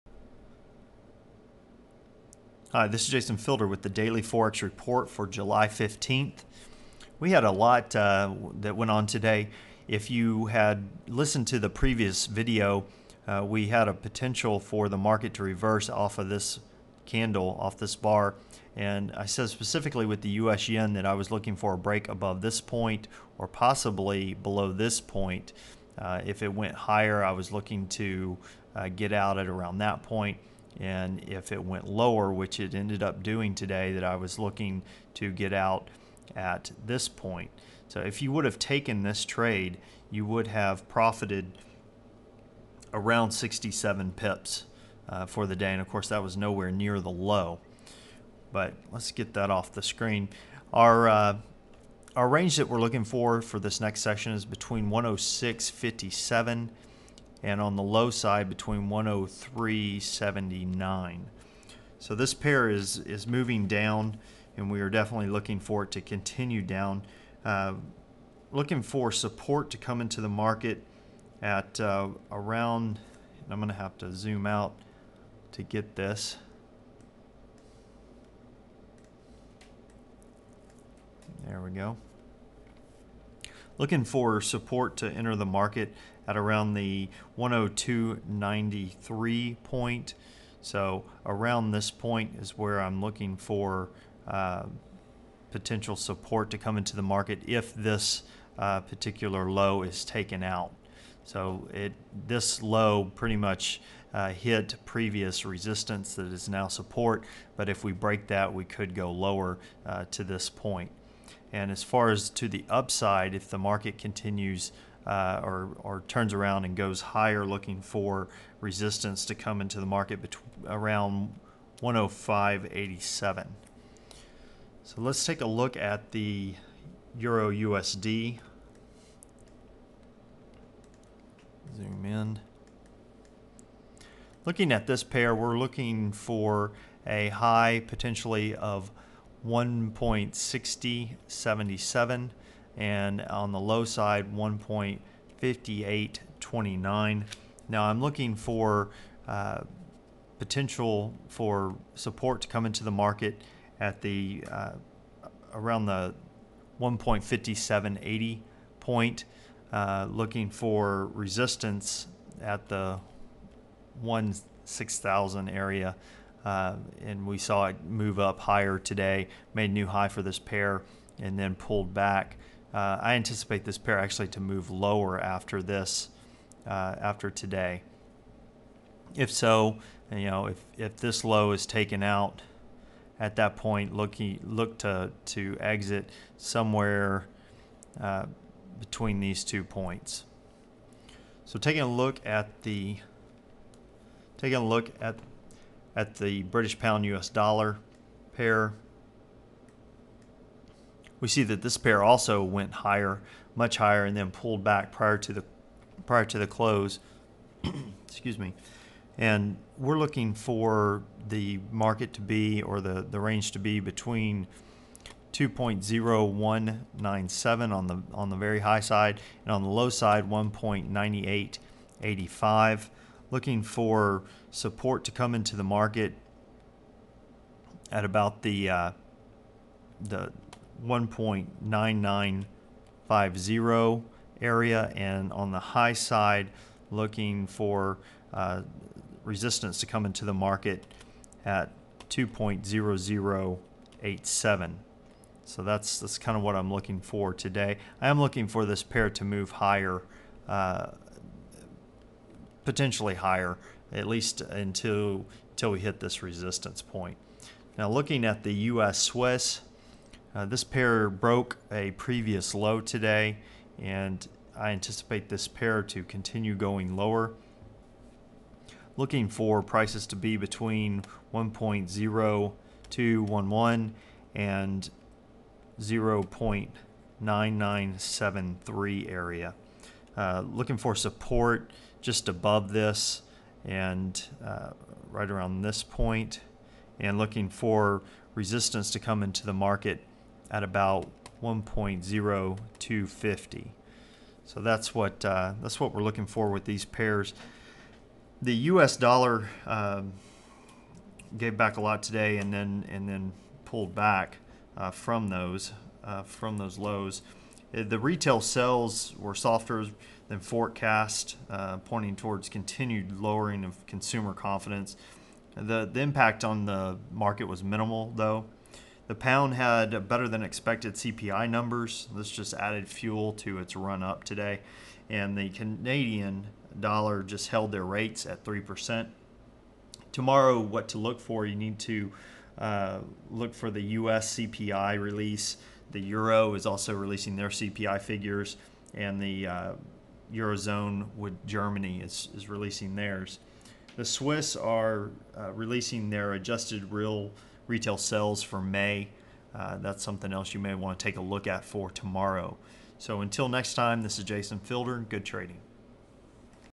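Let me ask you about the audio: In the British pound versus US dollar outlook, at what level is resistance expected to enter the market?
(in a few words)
2.0087.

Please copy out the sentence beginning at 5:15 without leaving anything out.
The, the impact on the market was minimal, though.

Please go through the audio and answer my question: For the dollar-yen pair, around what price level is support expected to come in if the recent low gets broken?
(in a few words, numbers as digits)
102.93.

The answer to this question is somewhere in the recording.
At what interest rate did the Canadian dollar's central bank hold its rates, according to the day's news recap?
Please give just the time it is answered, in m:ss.
5:28.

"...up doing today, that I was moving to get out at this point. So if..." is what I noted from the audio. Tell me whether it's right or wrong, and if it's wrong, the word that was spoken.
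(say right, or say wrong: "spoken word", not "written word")
wrong: "looking", not "moving".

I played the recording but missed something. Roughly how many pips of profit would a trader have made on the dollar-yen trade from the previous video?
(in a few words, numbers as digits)
67 pips.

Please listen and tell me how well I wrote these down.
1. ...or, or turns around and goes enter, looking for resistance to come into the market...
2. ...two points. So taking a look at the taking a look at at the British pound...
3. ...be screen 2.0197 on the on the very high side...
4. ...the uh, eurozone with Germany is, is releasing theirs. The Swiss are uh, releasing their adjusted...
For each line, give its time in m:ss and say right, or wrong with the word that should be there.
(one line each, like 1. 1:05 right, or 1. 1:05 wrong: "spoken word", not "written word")
1. 1:55 wrong: "higher", not "enter"
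2. 3:09 right
3. 3:33 wrong: "between", not "screen"
4. 5:39 right.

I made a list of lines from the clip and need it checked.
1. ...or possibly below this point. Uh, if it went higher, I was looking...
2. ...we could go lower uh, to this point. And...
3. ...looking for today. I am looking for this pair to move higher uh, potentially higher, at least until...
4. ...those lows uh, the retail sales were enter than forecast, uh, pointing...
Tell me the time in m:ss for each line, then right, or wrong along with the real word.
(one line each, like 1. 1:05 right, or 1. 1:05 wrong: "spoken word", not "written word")
1. 0:23 right
2. 1:48 right
3. 4:06 right
4. 5:06 wrong: "softer", not "enter".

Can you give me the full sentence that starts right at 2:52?
Uh, I anticipate this pair actually to move lower after this, uh, after today.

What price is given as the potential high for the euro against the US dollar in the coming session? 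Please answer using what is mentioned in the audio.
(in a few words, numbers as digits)
1.6077.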